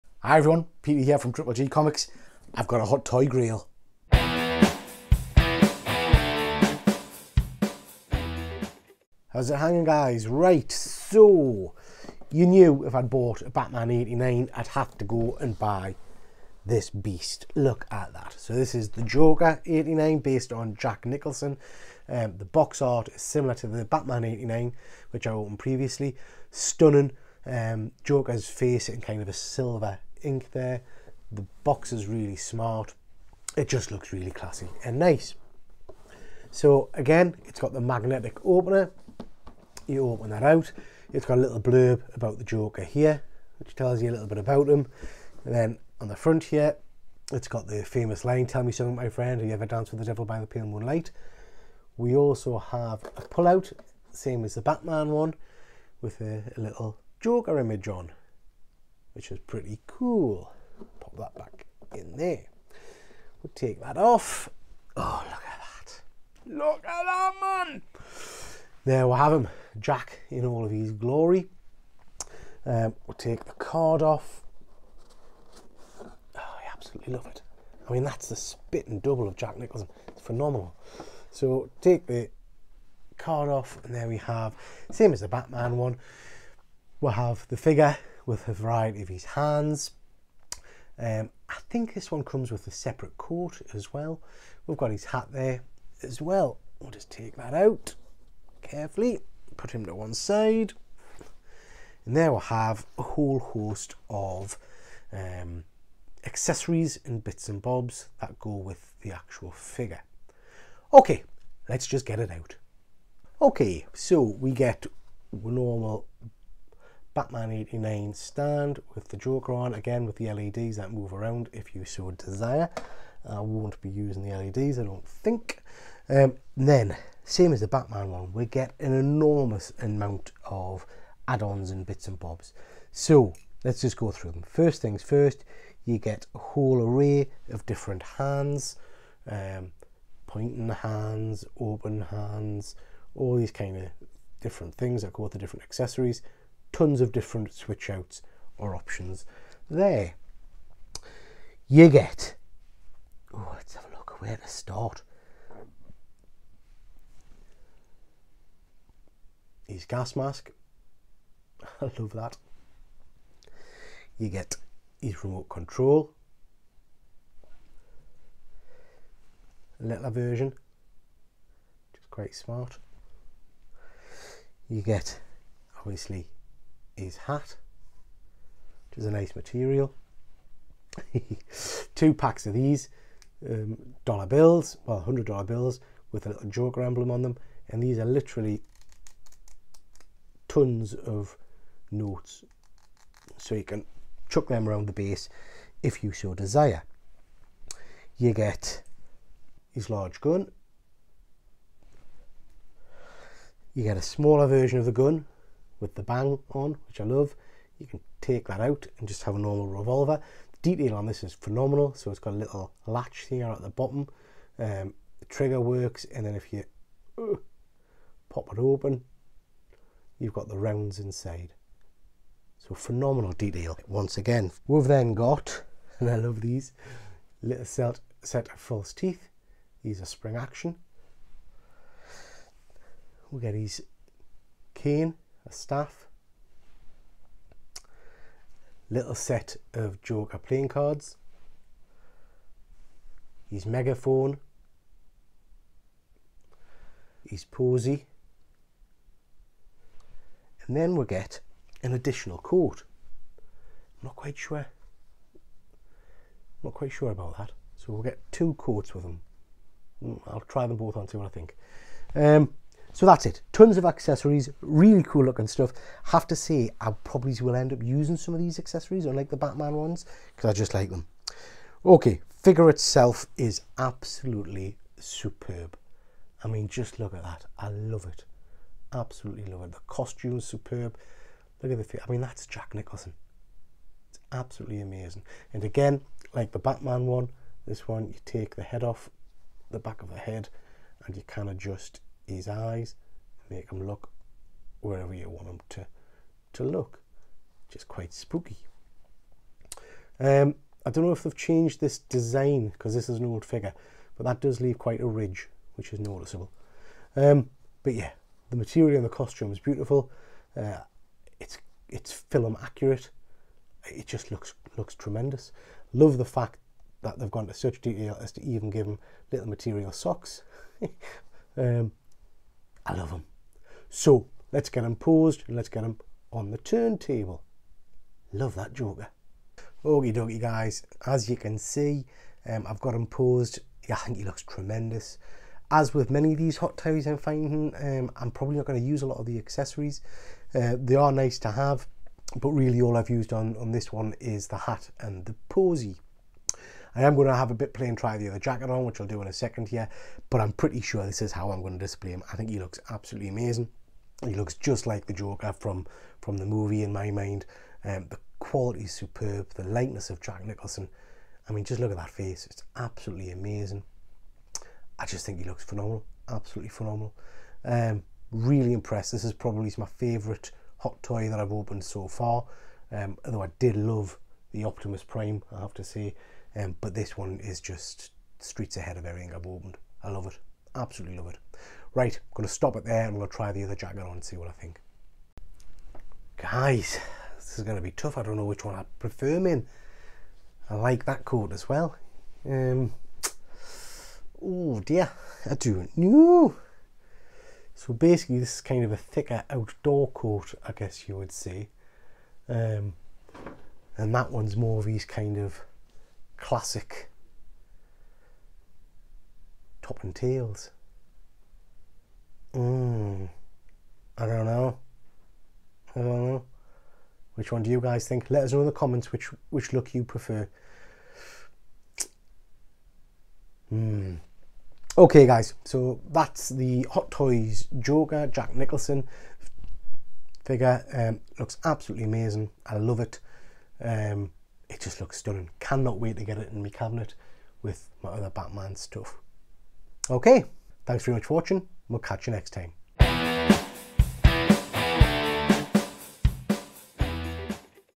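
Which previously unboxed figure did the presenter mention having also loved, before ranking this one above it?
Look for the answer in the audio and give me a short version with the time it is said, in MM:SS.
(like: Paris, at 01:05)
Optimus Prime, at 06:14.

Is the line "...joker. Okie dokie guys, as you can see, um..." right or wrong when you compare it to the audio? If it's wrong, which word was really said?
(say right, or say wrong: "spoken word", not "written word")
right.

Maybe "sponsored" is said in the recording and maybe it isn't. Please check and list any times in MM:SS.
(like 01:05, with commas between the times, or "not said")
not said.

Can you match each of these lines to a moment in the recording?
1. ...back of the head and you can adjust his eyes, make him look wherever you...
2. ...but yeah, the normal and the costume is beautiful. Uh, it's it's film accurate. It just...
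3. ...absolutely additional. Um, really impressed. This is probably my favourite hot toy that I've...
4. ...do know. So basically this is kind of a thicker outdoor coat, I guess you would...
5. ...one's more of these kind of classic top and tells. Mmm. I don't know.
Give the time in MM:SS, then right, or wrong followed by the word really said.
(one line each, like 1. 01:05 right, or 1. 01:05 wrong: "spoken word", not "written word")
1. 04:49 right
2. 05:07 wrong: "material", not "normal"
3. 06:06 wrong: "phenomenal", not "additional"
4. 06:35 right
5. 06:44 wrong: "tails", not "tells".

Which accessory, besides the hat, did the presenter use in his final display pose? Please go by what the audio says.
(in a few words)
Posy.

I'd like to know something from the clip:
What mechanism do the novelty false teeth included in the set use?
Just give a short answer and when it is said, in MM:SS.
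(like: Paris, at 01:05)
Spring action, at 03:50.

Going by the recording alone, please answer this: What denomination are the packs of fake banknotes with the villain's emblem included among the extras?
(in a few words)
100 dollar bills.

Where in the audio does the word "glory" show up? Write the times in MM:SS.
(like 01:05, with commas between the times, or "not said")
01:10.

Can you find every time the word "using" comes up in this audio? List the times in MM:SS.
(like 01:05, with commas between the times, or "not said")
02:03, 04:27.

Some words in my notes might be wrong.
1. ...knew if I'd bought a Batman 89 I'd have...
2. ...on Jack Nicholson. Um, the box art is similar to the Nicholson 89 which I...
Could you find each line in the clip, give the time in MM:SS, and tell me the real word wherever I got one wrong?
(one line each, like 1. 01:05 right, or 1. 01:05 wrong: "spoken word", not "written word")
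1. 00:12 right
2. 00:20 wrong: "Batman", not "Nicholson".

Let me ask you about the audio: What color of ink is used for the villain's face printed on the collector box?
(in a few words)
Silver.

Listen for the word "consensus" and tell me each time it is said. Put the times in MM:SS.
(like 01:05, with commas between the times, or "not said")
not said.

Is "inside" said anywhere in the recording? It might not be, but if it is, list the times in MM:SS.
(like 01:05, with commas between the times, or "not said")
03:40.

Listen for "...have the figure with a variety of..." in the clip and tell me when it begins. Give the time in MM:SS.
01:27.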